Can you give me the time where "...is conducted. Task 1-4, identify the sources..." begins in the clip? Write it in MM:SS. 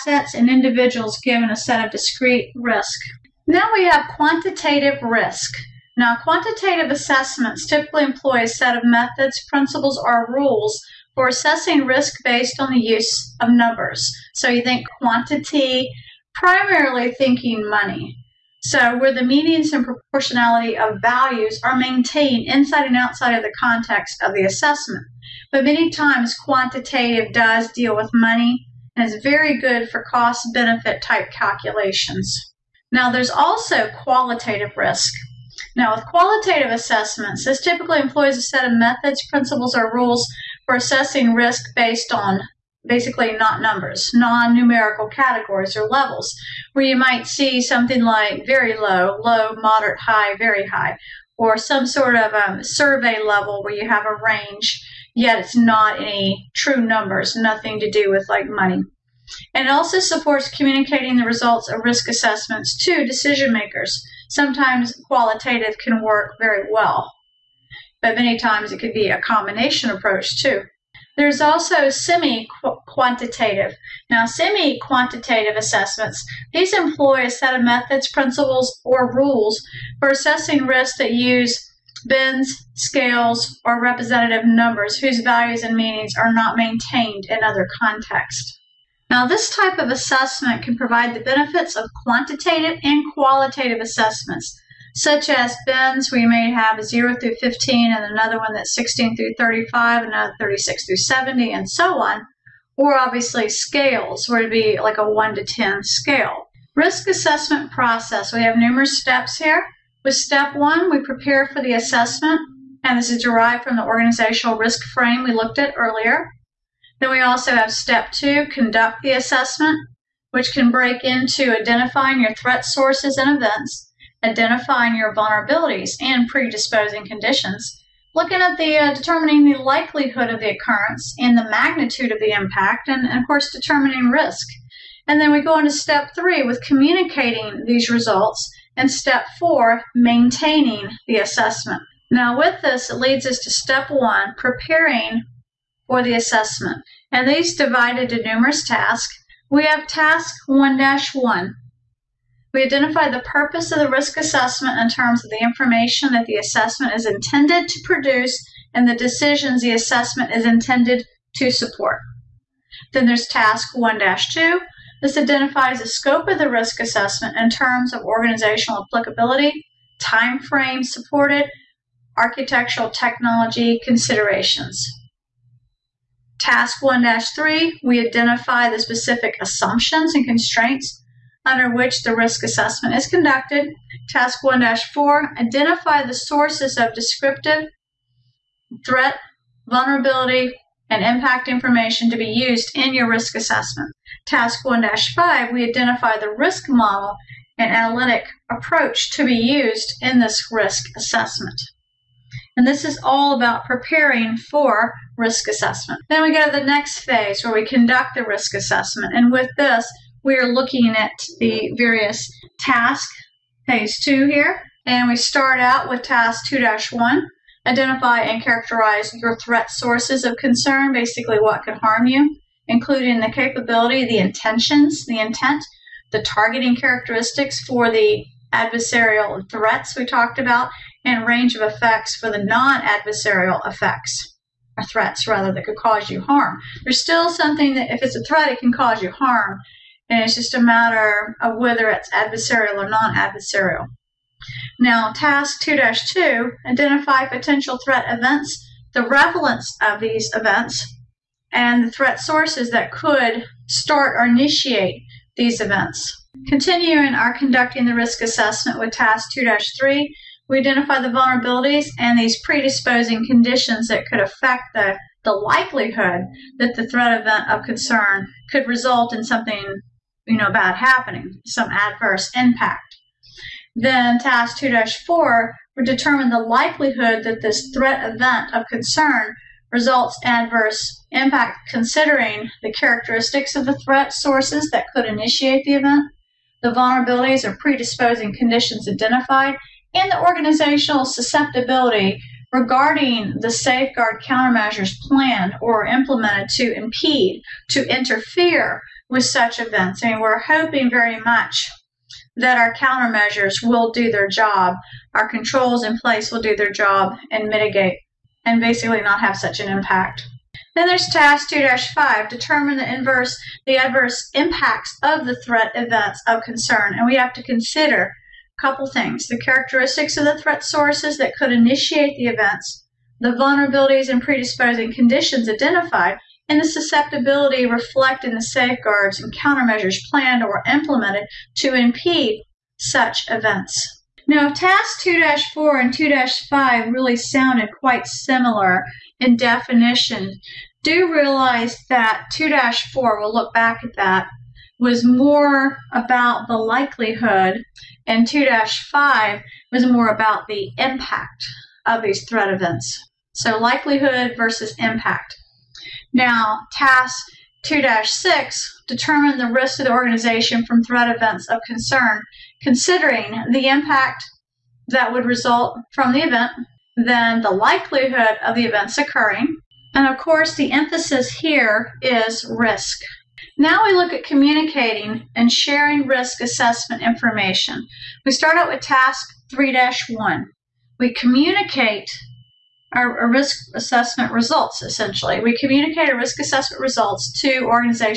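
03:02.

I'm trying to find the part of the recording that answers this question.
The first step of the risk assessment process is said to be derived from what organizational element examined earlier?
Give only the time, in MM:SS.
01:53.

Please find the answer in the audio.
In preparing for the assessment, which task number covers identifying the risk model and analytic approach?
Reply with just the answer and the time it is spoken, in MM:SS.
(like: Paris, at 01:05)
Task 1-5, at 03:14.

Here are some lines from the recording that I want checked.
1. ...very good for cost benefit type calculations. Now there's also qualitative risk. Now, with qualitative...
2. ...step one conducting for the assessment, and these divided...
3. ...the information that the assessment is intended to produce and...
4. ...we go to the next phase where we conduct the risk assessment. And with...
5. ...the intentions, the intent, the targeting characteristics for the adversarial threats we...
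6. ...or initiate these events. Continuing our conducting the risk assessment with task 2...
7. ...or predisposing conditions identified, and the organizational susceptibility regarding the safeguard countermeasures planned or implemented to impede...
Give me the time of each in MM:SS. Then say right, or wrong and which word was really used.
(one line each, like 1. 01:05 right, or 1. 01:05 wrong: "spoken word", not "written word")
1. 00:29 right
2. 02:23 wrong: "preparing", not "conducting"
3. 02:35 right
4. 03:26 right
5. 03:44 right
6. 04:14 right
7. 04:47 right.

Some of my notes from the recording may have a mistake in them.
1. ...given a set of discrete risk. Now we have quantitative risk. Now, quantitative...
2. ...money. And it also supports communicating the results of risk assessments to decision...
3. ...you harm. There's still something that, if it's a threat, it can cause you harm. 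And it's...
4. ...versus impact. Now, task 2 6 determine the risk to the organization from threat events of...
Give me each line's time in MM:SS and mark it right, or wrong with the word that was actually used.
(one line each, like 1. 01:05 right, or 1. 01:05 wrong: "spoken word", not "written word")
1. 00:01 right
2. 00:58 right
3. 03:56 right
4. 05:54 right.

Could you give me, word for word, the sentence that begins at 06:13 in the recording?
Now we look at communicating and sharing risk assessment information.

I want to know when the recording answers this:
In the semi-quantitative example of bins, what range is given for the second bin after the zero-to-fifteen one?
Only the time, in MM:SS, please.
01:38.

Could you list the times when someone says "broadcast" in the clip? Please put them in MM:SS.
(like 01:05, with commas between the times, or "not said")
not said.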